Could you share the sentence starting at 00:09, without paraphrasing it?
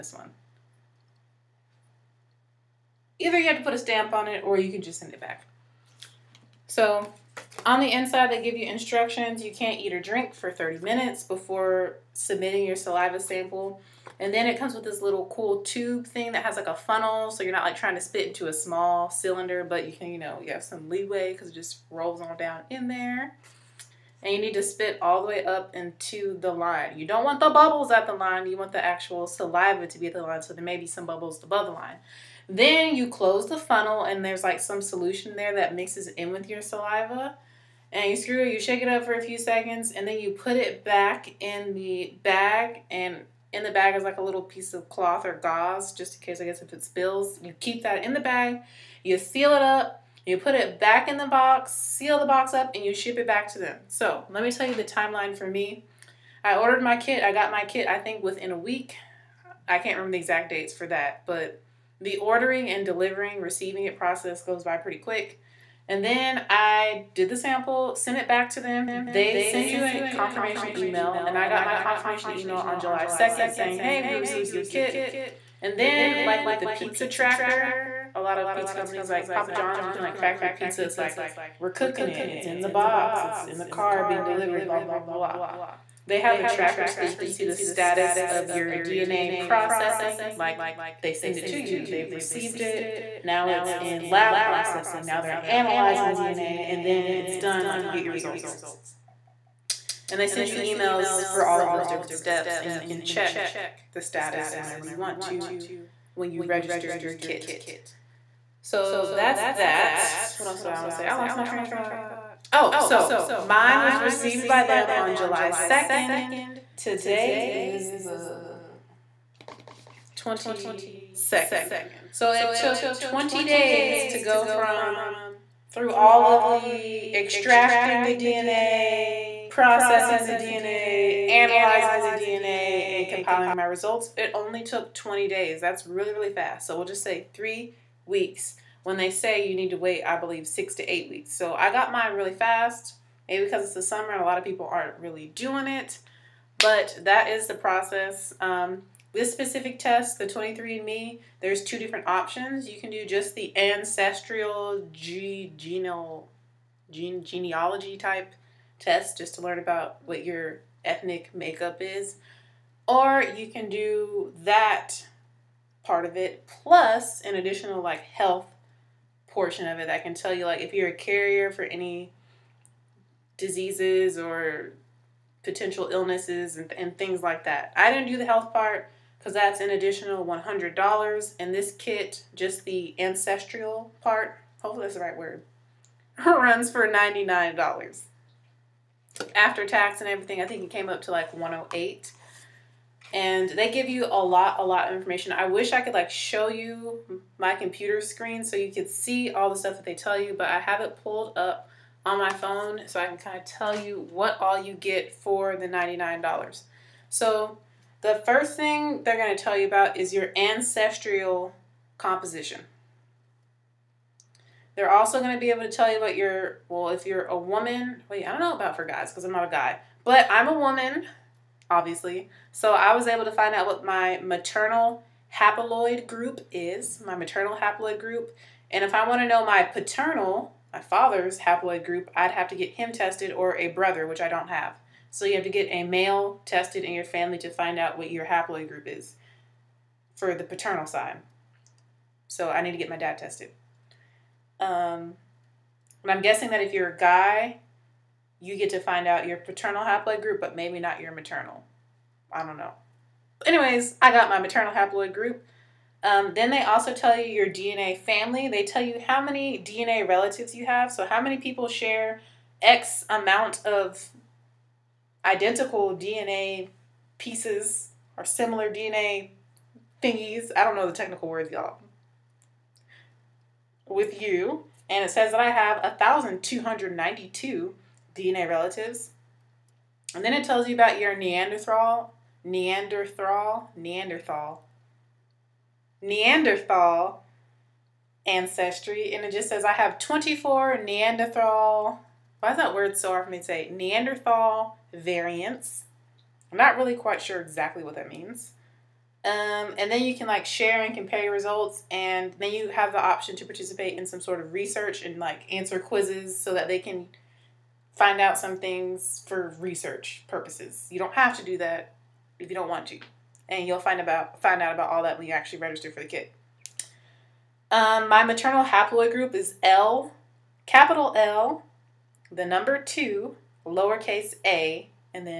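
You can't eat or drink for 30 minutes before submitting your saliva sample.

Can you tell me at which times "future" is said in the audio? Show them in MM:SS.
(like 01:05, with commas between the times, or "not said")
not said.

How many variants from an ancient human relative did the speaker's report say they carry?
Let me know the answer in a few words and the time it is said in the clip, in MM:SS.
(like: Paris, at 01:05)
24, at 04:49.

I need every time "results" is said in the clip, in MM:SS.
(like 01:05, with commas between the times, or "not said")
01:38, 02:13, 05:01.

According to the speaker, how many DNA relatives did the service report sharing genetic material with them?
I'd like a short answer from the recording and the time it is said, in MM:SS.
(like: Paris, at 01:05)
1,292, at 04:35.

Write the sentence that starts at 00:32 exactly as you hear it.
Then you close the funnel and there's like some solution there that mixes in with your saliva.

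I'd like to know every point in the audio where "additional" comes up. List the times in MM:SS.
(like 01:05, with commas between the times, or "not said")
02:47, 02:59.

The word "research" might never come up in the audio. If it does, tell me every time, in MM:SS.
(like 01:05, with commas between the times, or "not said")
05:04, 05:09.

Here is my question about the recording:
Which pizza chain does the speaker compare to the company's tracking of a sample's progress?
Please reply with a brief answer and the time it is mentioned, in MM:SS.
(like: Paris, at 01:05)
Papa John's, at 01:19.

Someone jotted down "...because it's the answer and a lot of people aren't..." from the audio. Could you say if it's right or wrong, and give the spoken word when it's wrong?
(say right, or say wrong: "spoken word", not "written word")
wrong: "summer", not "answer".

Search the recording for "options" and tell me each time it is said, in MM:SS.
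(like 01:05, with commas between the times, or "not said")
02:32, 05:03.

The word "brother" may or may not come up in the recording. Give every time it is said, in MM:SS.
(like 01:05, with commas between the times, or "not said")
03:53.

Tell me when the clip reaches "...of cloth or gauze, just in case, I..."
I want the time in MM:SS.
00:44.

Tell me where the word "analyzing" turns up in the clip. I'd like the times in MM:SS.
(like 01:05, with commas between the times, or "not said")
01:35, 02:11.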